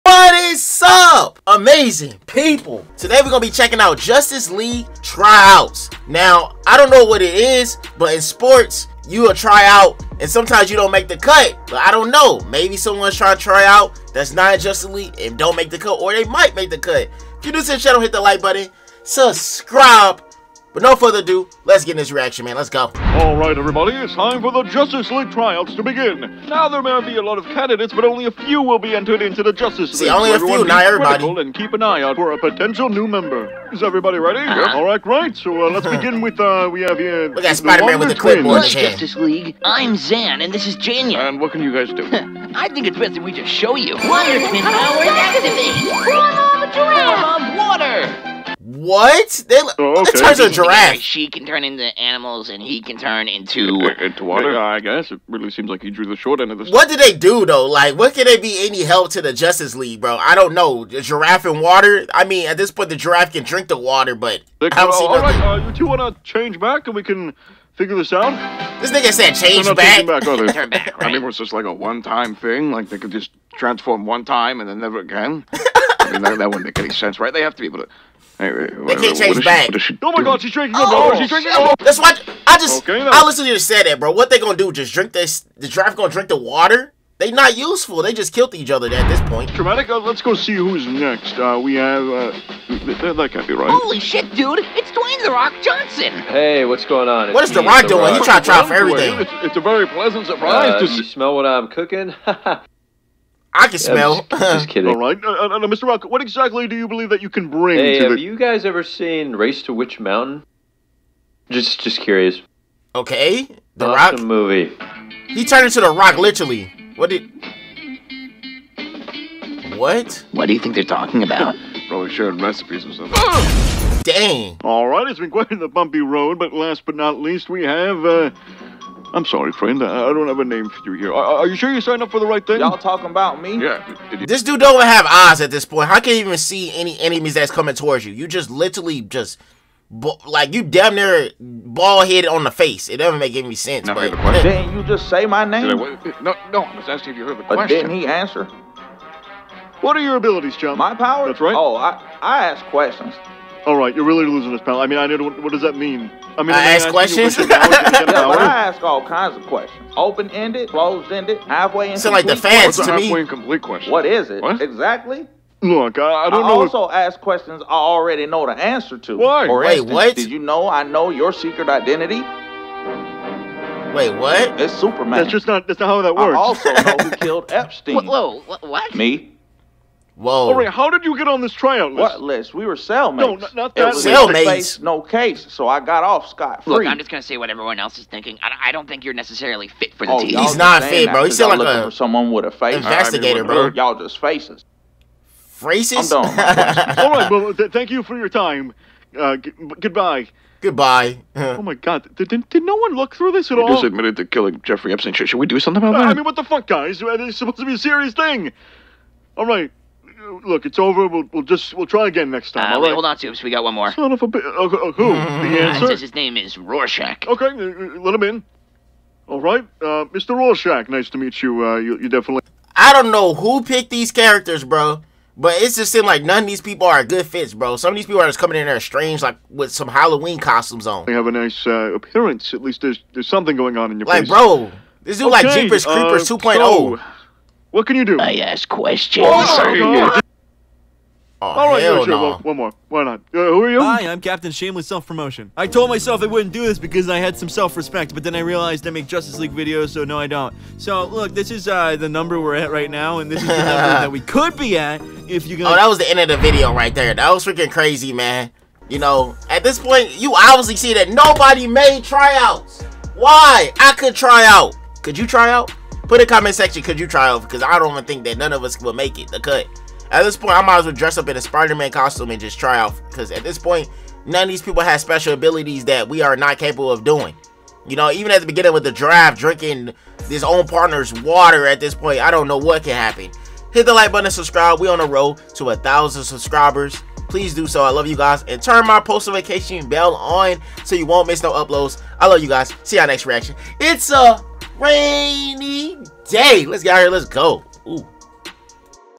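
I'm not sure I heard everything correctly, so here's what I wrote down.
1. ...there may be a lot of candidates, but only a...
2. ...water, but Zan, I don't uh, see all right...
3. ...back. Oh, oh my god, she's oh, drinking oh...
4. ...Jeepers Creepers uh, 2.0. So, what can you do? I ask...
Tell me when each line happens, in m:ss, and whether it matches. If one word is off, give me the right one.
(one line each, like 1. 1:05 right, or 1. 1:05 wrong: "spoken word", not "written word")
1. 0:26 right
2. 1:03 wrong: "Nick", not "Zan"
3. 1:19 right
4. 3:55 right.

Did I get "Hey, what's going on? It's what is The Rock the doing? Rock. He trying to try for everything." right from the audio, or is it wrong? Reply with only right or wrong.
right.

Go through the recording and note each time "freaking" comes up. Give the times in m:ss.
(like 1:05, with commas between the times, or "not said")
4:17.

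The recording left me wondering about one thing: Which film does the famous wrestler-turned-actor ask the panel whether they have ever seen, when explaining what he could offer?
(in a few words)
Race to Witch Mountain.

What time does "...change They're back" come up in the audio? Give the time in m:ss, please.
1:09.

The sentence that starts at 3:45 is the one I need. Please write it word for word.
But it just seemed like none of these people are good fits, bro.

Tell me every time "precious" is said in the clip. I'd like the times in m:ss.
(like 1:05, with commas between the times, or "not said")
not said.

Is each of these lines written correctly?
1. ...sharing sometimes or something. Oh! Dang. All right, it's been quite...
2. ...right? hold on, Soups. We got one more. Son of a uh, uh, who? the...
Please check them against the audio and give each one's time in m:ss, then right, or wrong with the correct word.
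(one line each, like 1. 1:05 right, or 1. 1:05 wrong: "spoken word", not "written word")
1. 2:02 wrong: "recipes", not "sometimes"
2. 3:32 right.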